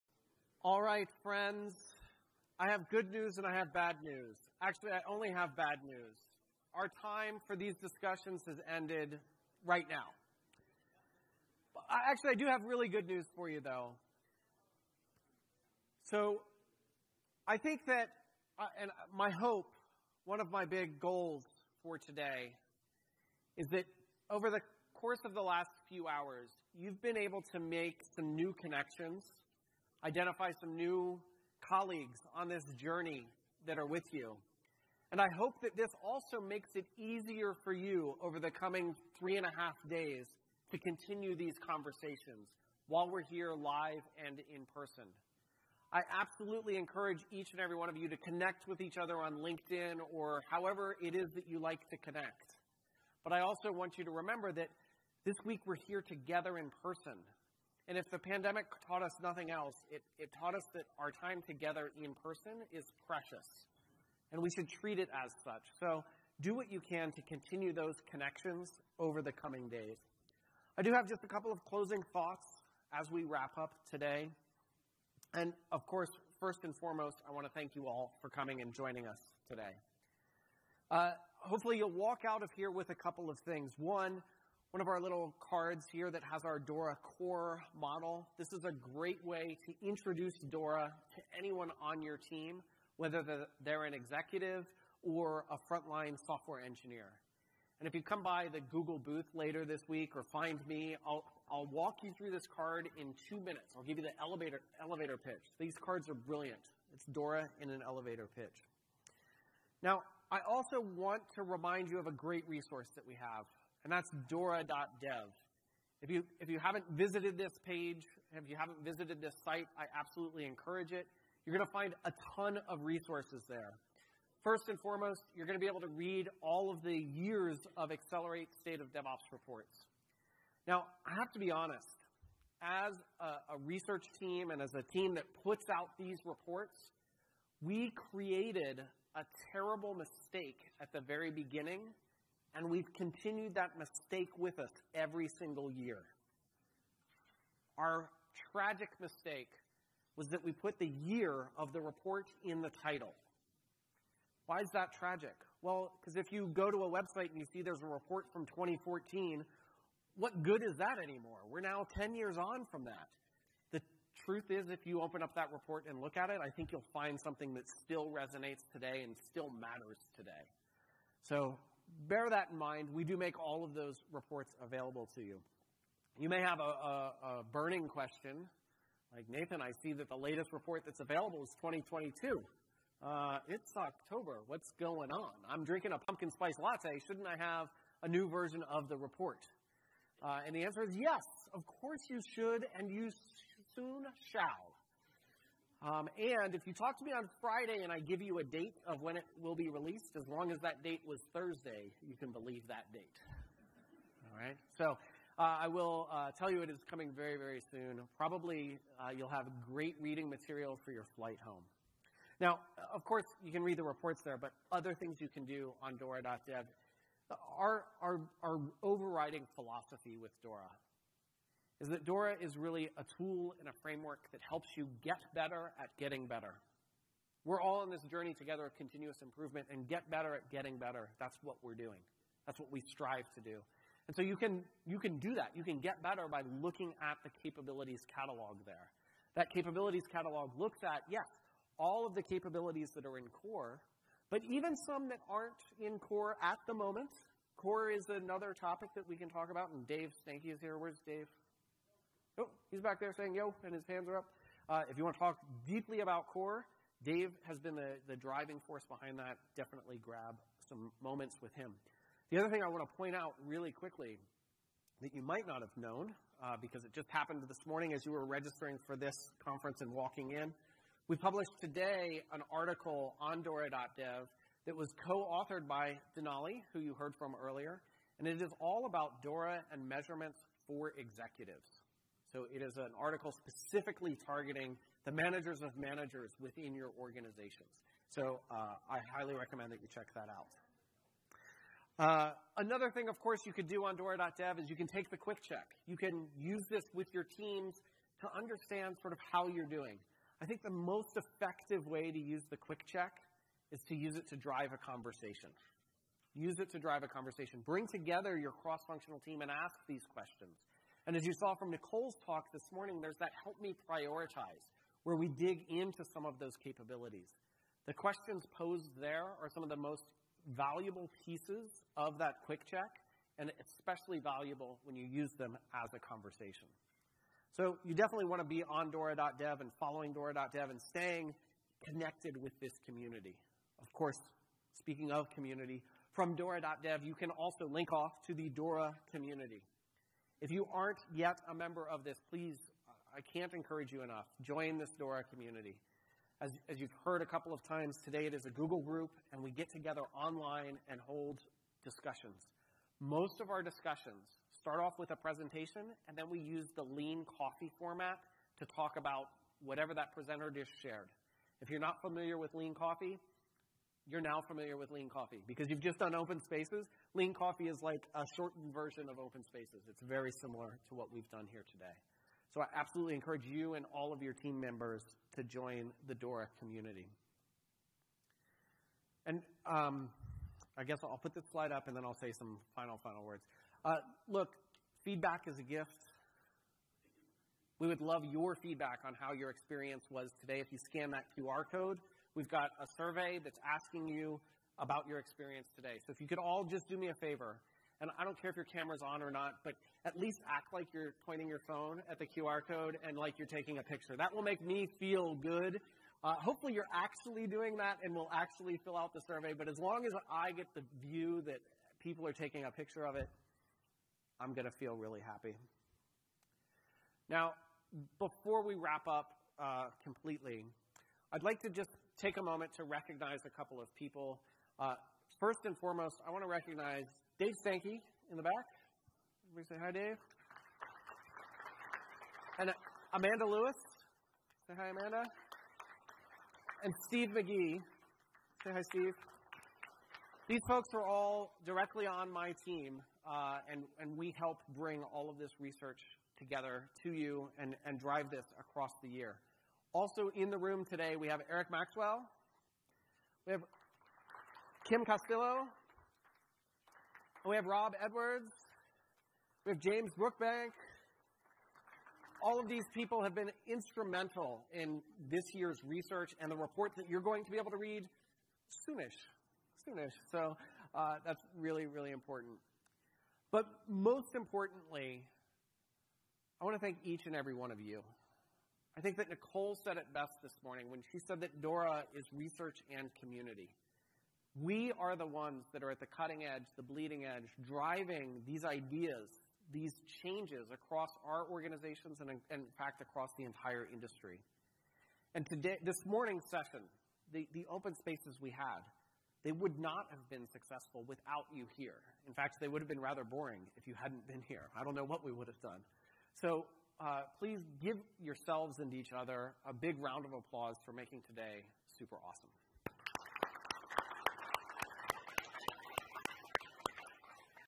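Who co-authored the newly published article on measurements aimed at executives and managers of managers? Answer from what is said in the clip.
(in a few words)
Denali.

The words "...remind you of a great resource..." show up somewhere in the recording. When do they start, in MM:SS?
01:51.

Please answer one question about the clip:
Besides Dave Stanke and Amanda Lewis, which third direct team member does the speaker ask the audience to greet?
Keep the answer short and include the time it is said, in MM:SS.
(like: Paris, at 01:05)
Steve McGhee, at 07:17.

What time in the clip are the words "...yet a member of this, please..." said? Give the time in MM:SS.
05:41.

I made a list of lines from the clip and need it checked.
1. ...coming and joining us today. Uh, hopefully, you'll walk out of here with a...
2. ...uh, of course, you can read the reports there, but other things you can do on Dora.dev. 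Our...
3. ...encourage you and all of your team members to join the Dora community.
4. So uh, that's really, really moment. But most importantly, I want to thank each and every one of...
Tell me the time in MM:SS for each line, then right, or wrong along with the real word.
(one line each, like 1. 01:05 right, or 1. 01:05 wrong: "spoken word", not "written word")
1. 01:18 right
2. 03:32 right
3. 06:13 right
4. 07:50 wrong: "important", not "moment".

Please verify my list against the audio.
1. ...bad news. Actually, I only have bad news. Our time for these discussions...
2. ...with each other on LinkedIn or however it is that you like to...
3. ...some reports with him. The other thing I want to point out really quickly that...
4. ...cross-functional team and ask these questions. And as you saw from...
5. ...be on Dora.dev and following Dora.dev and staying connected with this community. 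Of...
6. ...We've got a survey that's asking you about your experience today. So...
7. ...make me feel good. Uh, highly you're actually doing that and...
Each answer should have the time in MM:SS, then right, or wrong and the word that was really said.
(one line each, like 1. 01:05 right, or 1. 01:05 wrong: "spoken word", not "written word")
1. 00:03 right
2. 00:48 right
3. 04:20 wrong: "moments", not "reports"
4. 05:08 right
5. 05:28 right
6. 06:32 right
7. 06:44 wrong: "hopefully", not "highly".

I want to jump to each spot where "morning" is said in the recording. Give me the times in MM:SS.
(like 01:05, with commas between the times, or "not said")
04:27, 05:12, 08:00, 08:16.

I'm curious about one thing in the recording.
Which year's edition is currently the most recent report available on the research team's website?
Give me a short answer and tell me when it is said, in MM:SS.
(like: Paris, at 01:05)
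2022, at 03:01.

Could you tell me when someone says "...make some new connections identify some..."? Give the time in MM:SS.
00:27.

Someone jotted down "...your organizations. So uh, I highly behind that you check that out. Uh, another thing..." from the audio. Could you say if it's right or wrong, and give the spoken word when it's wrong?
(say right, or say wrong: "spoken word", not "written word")
wrong: "recommend", not "behind".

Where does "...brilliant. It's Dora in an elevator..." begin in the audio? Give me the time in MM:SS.
01:46.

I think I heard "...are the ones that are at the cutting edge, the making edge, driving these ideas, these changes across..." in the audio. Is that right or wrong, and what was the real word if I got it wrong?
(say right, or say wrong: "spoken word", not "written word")
wrong: "bleeding", not "making".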